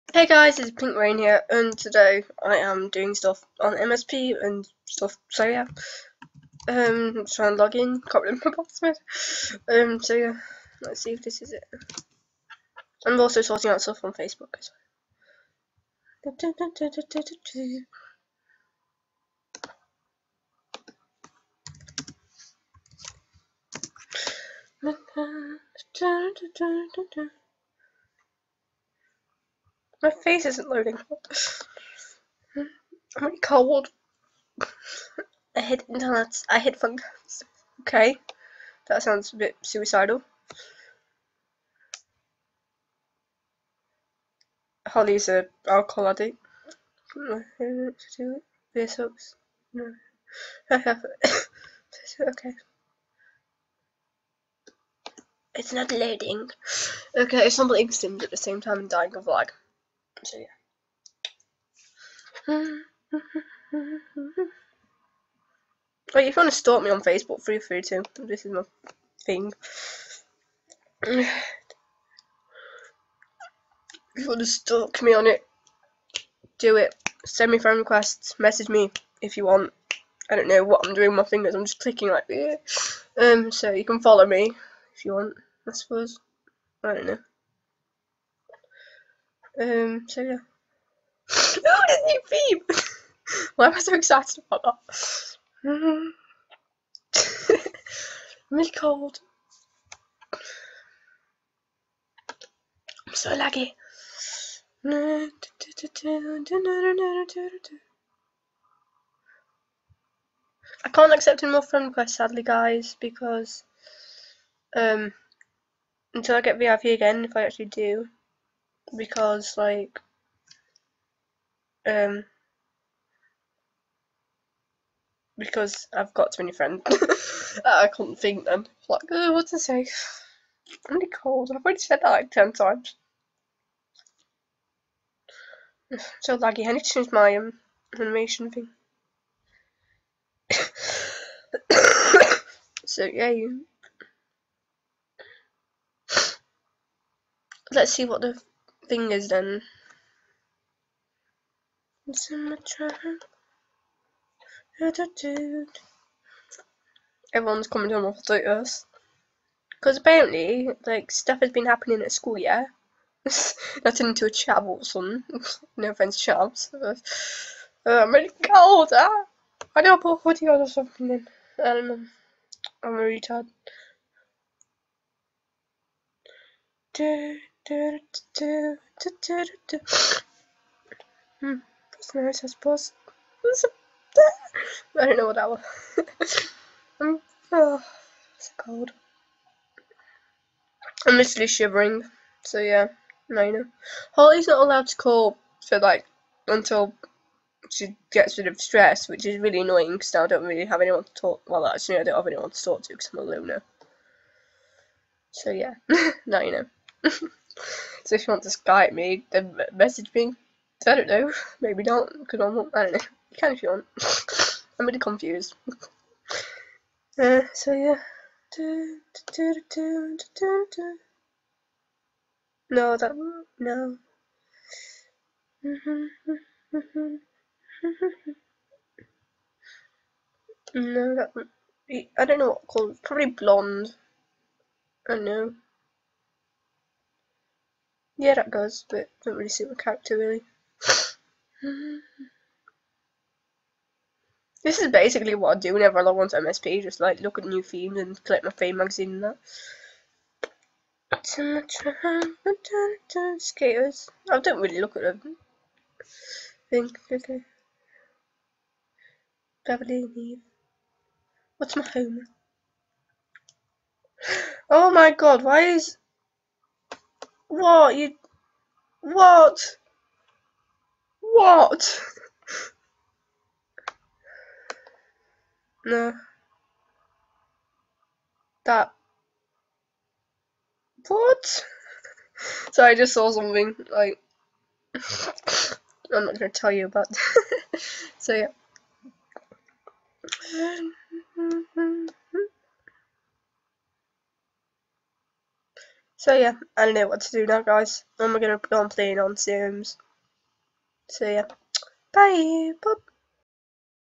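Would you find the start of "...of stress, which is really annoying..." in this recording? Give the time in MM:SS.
03:18.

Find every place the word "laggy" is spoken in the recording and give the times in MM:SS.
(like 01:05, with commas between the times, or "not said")
01:43, 02:16.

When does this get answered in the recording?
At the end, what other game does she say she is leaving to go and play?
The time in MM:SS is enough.
04:59.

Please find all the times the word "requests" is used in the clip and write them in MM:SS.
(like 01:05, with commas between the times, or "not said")
01:17, 01:51.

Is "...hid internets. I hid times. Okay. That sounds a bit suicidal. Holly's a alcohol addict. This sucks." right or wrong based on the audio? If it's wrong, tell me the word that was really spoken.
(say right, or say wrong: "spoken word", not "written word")
wrong: "phones", not "times".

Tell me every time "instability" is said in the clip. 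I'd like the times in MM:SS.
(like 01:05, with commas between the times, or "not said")
not said.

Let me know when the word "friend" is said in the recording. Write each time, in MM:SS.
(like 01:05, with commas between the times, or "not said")
01:17, 01:51, 02:06.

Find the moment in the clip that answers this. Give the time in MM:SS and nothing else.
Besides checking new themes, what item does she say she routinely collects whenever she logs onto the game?
04:08.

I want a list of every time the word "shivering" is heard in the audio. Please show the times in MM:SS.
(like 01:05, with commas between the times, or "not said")
03:11.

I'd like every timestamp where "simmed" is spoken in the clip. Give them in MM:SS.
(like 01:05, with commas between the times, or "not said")
00:57.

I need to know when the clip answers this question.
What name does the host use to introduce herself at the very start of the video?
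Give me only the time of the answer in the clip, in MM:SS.
00:00.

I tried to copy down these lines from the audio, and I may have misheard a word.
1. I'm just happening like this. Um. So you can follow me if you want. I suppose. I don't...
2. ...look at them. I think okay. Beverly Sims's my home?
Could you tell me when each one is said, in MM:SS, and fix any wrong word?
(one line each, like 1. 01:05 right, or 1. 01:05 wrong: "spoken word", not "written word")
1. 01:21 wrong: "clicking", not "happening"
2. 04:14 wrong: "What", not "Sims".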